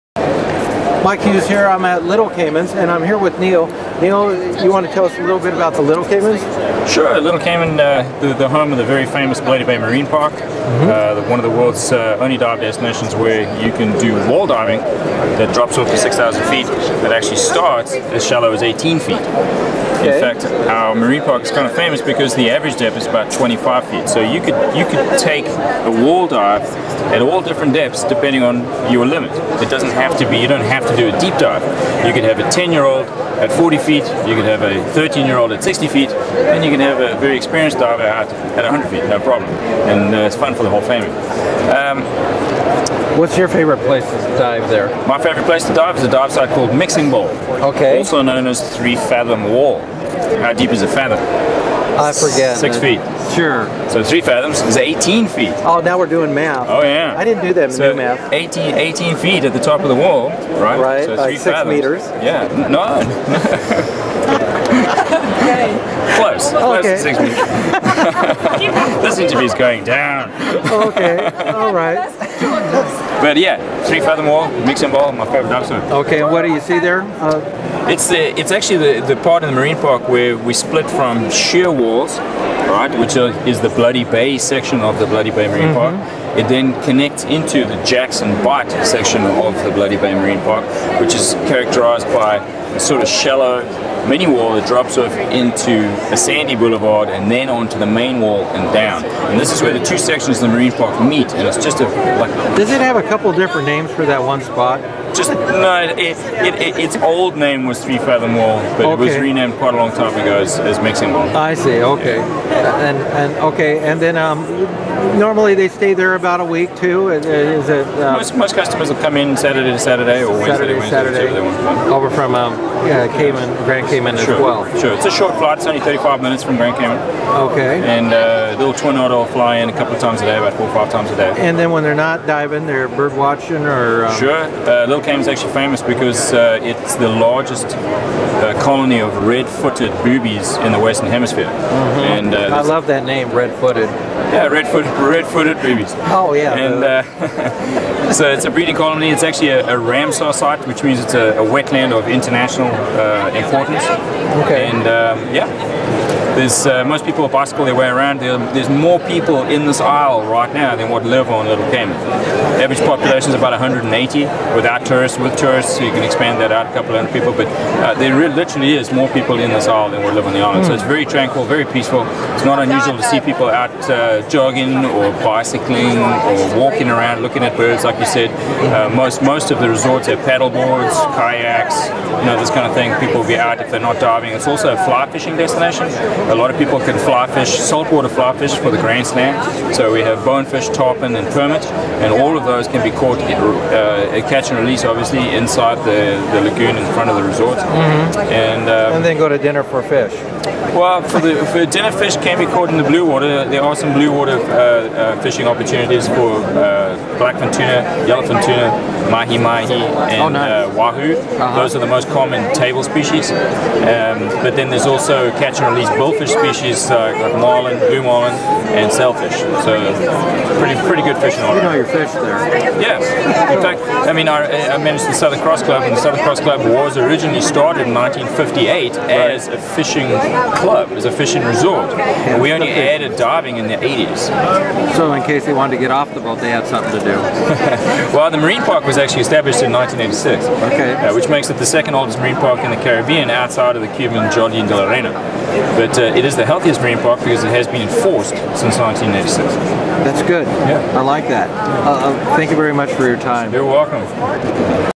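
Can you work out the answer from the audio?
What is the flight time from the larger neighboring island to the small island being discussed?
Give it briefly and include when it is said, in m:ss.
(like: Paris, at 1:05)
35 minutes, at 2:05.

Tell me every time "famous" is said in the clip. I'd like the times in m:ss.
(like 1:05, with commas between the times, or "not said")
0:09, 0:21, 2:15.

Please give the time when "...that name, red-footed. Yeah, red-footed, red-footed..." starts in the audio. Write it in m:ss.
2:22.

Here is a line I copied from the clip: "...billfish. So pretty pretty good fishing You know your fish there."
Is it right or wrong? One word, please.
wrong.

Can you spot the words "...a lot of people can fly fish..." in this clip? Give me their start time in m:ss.
3:06.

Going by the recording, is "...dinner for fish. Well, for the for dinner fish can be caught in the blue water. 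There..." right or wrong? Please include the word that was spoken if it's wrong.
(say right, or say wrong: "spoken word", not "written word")
right.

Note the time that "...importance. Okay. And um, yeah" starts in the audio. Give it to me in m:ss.
2:33.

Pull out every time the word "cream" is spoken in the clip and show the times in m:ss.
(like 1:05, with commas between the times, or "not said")
not said.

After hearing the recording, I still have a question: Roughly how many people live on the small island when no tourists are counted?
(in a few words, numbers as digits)
180.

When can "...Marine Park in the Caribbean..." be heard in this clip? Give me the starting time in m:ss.
4:02.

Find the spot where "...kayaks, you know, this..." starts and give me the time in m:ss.
3:01.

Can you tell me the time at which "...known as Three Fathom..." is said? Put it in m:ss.
0:48.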